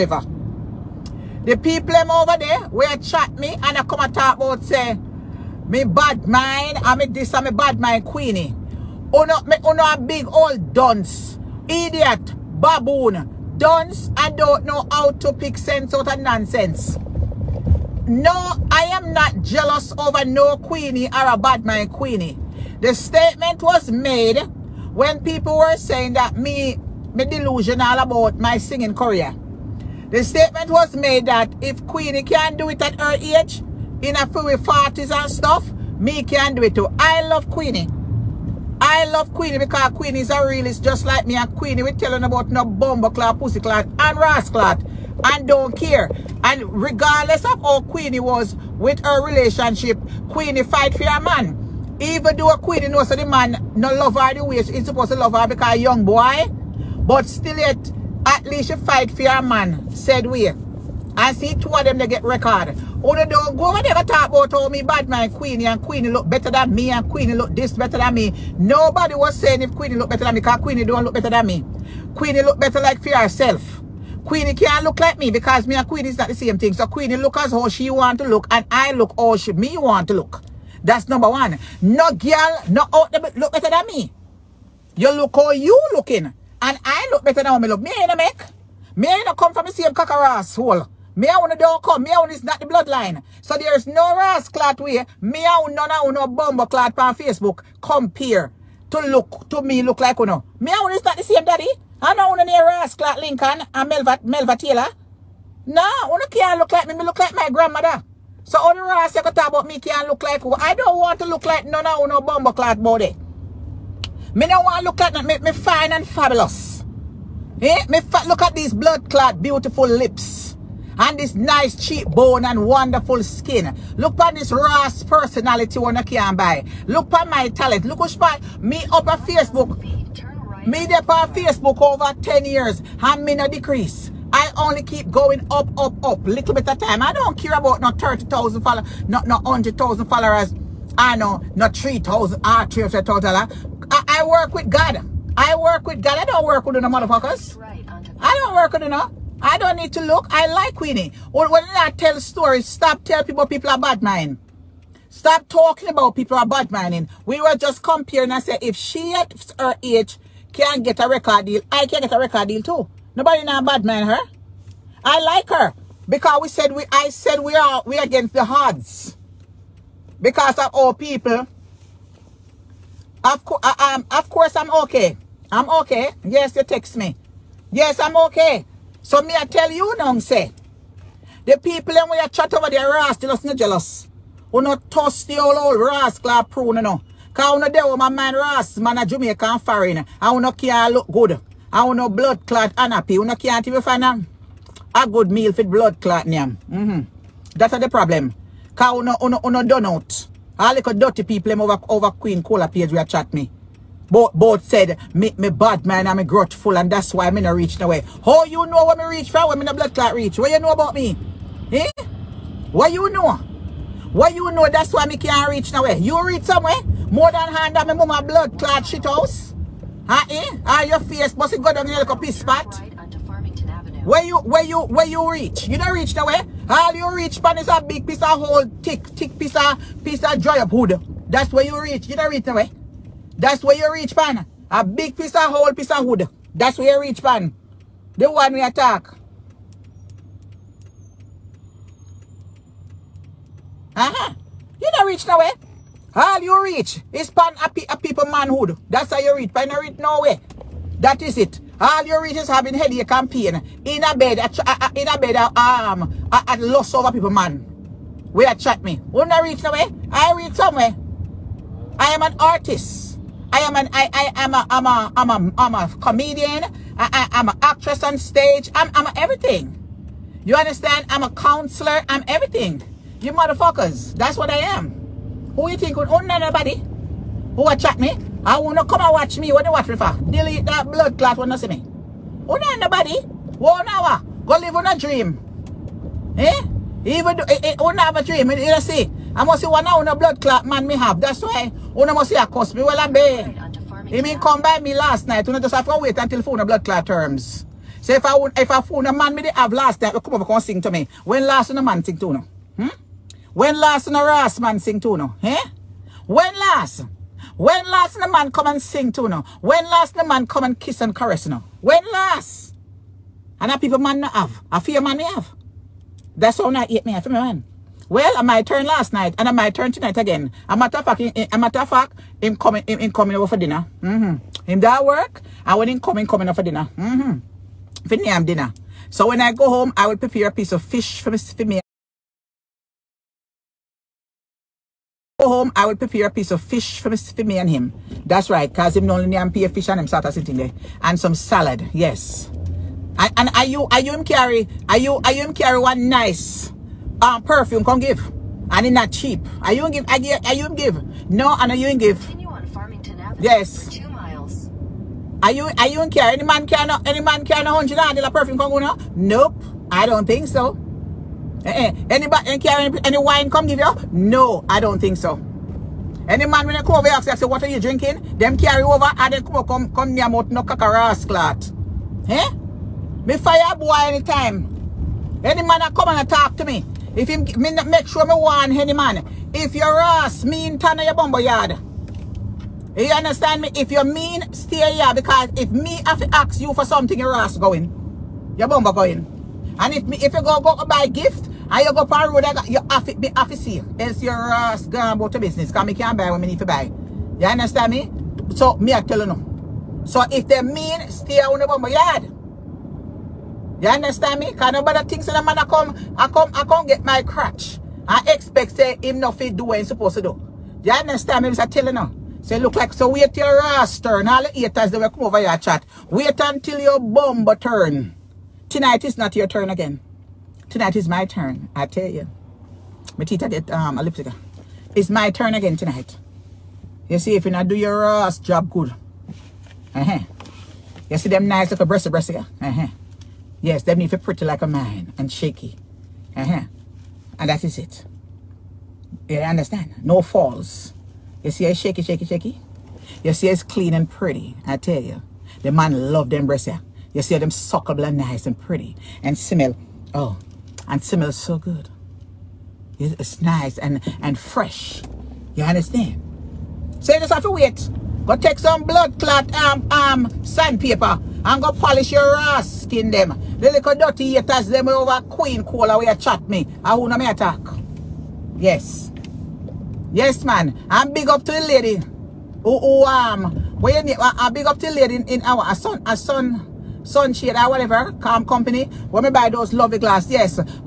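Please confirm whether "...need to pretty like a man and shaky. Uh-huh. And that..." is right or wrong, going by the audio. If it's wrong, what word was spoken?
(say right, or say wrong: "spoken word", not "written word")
right.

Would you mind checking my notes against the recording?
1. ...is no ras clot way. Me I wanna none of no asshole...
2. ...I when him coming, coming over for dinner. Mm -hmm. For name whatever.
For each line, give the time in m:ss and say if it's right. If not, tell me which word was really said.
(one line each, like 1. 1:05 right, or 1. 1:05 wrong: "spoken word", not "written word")
1. 1:33 wrong: "bumble", not "asshole"
2. 5:25 wrong: "dinner", not "whatever".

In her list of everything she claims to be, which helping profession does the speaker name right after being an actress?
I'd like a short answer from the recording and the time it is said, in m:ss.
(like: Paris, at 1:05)
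Counselor, at 4:31.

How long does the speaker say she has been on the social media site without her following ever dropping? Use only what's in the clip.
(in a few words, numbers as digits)
Over 10 years.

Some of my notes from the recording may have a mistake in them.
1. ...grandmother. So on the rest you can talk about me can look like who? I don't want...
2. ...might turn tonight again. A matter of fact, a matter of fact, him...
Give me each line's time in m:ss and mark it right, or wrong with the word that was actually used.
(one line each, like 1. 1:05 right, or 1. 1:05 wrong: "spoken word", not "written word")
1. 1:47 right
2. 5:19 right.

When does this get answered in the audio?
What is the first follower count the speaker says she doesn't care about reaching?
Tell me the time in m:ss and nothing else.
2:17.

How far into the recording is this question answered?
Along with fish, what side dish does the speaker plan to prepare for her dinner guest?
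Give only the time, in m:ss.
5:41.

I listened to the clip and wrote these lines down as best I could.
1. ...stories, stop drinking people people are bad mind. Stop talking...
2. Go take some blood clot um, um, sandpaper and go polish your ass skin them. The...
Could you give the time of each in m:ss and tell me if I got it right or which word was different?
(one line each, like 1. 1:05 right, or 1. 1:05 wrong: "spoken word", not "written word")
1. 2:32 wrong: "telling", not "drinking"
2. 7:38 right.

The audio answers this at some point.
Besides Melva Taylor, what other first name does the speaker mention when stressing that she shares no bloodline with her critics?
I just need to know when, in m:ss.
1:43.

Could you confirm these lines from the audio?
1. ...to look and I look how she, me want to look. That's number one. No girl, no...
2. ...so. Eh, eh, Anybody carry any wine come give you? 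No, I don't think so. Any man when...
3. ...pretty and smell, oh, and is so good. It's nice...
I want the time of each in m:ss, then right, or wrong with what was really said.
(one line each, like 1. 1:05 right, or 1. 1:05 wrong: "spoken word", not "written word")
1. 1:18 right
2. 6:00 right
3. 7:28 right.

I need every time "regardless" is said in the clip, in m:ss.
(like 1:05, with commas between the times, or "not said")
0:46.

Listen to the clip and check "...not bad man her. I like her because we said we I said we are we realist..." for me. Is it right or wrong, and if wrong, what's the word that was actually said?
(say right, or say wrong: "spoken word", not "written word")
wrong: "against", not "realist".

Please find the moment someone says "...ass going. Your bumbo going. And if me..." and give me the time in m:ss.
6:27.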